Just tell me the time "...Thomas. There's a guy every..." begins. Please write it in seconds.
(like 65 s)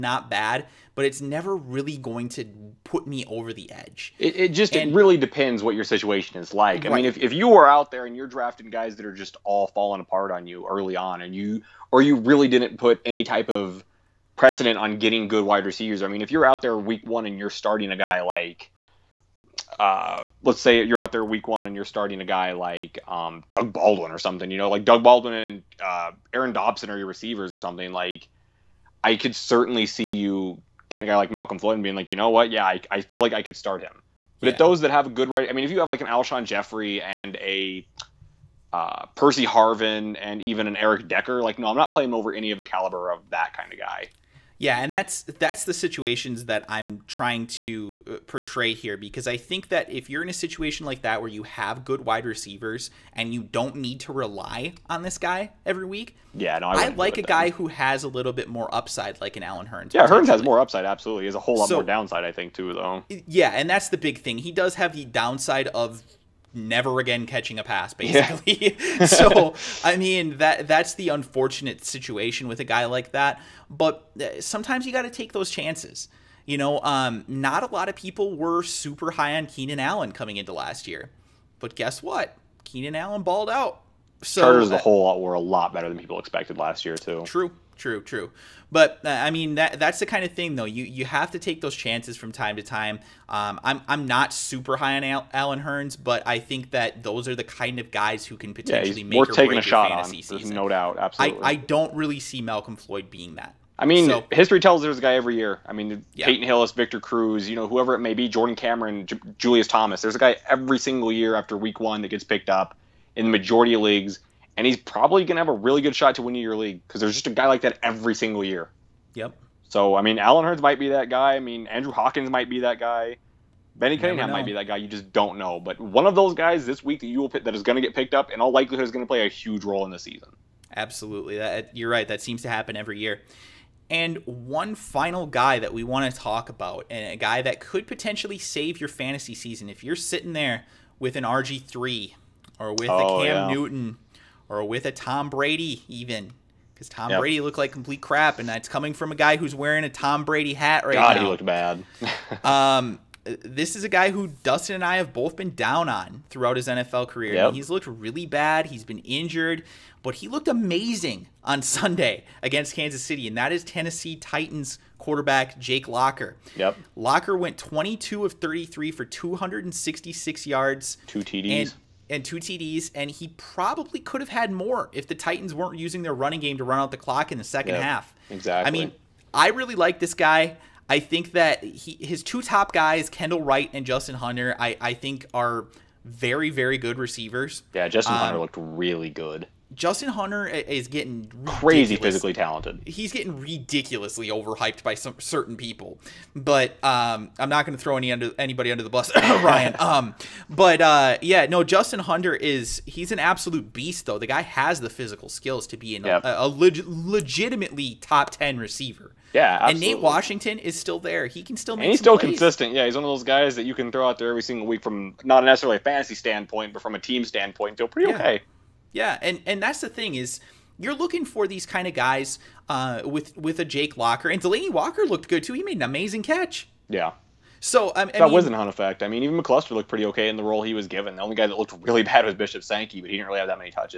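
109 s.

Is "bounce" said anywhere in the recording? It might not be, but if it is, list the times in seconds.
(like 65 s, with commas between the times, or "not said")
not said.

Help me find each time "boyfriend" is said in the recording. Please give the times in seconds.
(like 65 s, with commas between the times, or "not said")
not said.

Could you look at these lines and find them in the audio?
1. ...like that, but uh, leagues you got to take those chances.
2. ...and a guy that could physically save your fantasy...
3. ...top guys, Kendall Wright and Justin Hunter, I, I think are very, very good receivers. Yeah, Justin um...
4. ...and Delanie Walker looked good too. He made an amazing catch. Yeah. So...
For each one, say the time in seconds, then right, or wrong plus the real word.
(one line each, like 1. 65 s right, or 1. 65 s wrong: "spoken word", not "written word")
1. 72 s wrong: "sometimes", not "leagues"
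2. 136 s wrong: "potentially", not "physically"
3. 182 s right
4. 224 s right.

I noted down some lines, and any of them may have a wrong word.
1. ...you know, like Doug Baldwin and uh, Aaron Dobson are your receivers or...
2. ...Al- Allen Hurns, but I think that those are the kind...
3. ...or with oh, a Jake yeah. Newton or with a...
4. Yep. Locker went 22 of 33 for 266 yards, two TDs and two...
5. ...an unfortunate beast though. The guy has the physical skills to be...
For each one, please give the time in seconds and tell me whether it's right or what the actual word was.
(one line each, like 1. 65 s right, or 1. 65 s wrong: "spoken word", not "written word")
1. 24 s right
2. 95 s right
3. 142 s wrong: "Cam", not "Jake"
4. 166 s right
5. 203 s wrong: "absolute", not "unfortunate".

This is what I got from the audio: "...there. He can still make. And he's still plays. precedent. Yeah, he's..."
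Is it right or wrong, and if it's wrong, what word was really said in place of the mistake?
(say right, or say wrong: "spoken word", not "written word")
wrong: "consistent", not "precedent".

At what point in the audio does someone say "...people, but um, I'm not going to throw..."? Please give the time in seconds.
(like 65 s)
195 s.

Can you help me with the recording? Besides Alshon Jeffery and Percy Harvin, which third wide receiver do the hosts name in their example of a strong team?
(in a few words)
Eric Decker.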